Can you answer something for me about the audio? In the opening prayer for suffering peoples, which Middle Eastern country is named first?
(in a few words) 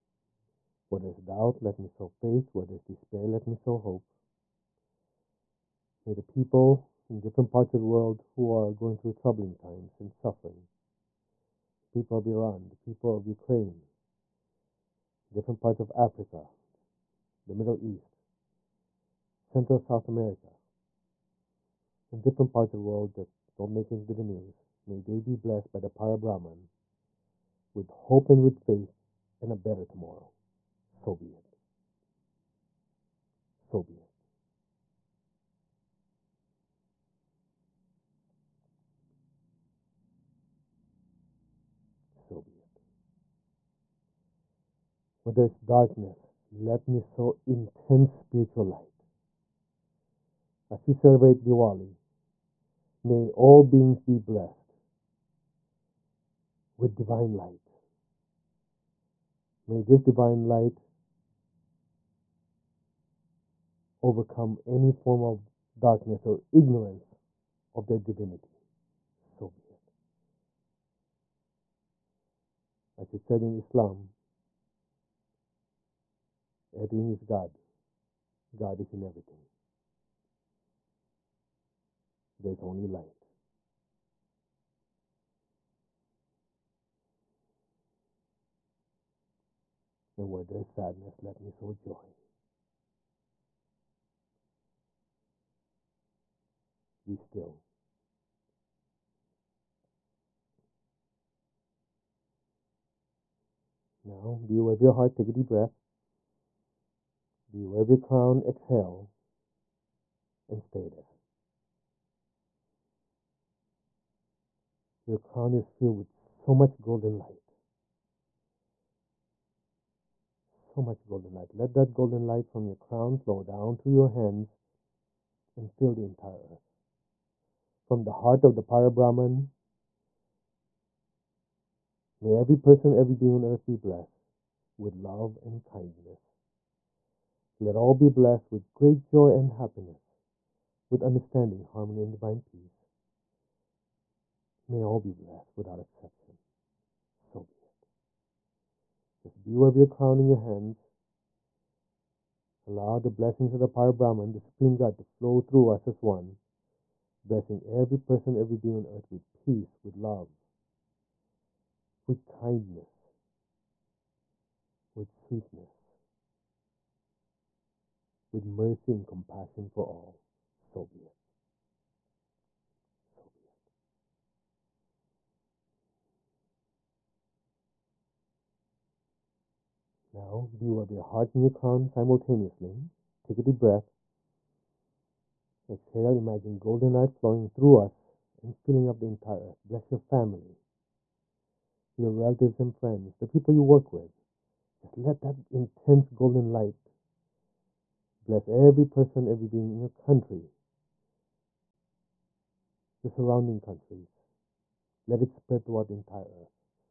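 Iran.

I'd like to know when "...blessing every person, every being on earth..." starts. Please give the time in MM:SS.
02:37.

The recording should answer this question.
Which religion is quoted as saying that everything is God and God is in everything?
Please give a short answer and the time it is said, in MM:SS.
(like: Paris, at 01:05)
Islam, at 01:13.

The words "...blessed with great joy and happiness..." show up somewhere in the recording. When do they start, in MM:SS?
02:18.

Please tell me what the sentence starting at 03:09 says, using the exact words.
Bless your family, your relatives and friends, the people you work with.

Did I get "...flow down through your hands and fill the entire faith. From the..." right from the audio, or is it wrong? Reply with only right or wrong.
wrong.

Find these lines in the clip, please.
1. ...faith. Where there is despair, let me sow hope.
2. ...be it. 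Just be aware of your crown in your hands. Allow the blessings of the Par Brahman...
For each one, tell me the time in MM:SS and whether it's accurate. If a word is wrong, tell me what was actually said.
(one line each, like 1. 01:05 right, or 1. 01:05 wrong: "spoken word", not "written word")
1. 00:02 right
2. 02:27 right.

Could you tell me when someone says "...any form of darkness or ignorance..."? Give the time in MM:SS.
01:04.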